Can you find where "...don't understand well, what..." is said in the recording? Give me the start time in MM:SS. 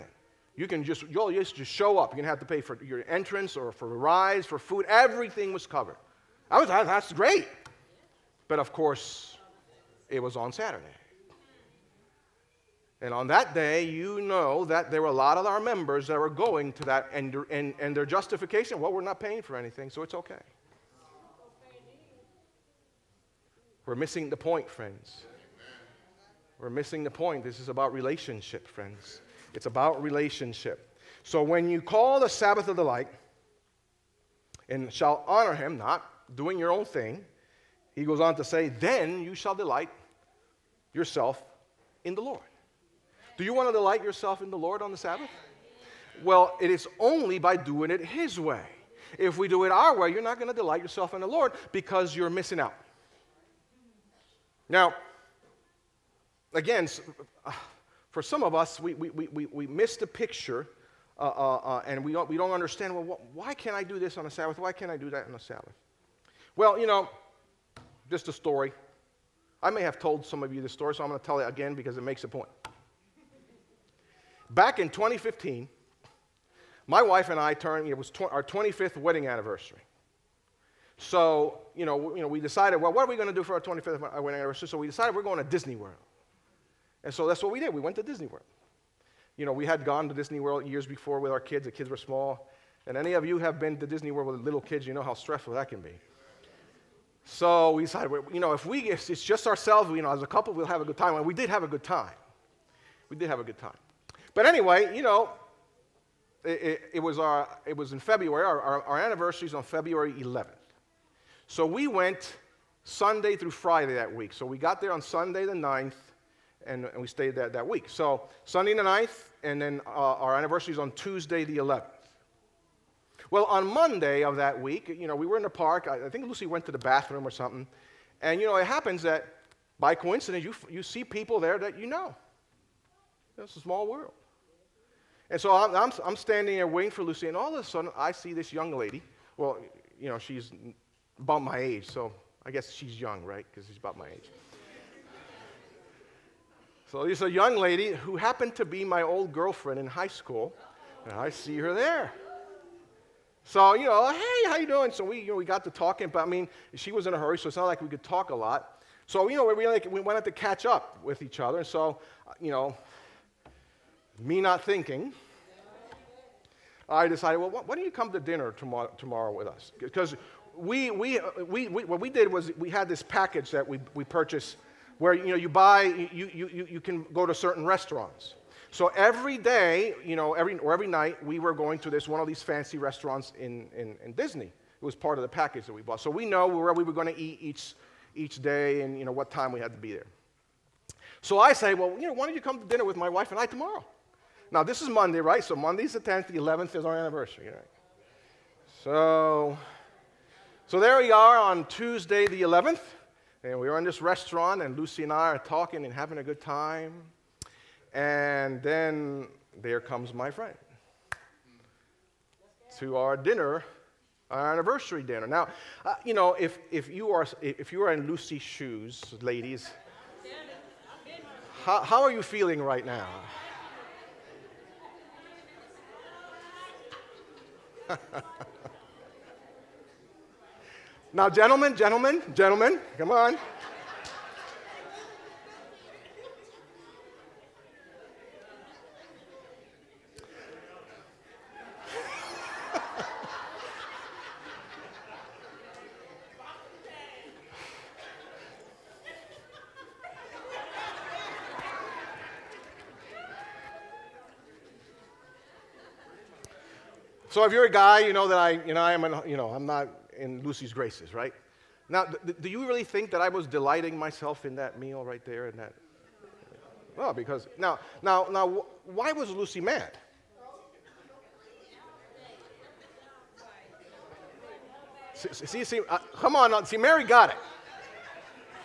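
01:02.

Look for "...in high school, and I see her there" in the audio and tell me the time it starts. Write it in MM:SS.
02:29.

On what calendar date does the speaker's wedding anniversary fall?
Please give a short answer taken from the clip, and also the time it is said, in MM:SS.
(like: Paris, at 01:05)
February 11th, at 01:49.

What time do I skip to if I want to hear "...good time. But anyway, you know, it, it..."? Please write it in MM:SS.
01:43.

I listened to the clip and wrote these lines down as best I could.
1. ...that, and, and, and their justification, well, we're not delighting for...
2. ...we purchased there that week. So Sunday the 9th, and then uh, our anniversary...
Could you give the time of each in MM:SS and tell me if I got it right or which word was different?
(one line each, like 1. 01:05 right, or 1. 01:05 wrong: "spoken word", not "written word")
1. 00:16 wrong: "paying", not "delighting"
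2. 01:57 wrong: "stayed", not "purchased".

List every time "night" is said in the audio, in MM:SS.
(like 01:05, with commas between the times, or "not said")
03:00.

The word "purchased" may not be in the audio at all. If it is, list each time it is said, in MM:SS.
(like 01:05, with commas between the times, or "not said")
02:54.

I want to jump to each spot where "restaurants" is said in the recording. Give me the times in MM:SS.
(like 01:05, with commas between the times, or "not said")
02:57, 03:02, 03:24.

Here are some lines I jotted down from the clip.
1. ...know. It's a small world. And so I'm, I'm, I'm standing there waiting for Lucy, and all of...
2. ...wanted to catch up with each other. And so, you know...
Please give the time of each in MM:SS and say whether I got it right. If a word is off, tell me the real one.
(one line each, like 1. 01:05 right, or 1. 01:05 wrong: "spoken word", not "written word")
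1. 02:11 right
2. 02:40 right.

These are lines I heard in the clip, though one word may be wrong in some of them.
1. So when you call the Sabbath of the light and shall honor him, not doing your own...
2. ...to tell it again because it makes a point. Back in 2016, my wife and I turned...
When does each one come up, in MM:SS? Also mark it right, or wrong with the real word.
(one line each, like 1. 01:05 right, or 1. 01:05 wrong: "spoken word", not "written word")
1. 00:31 right
2. 01:11 wrong: "2015", not "2016".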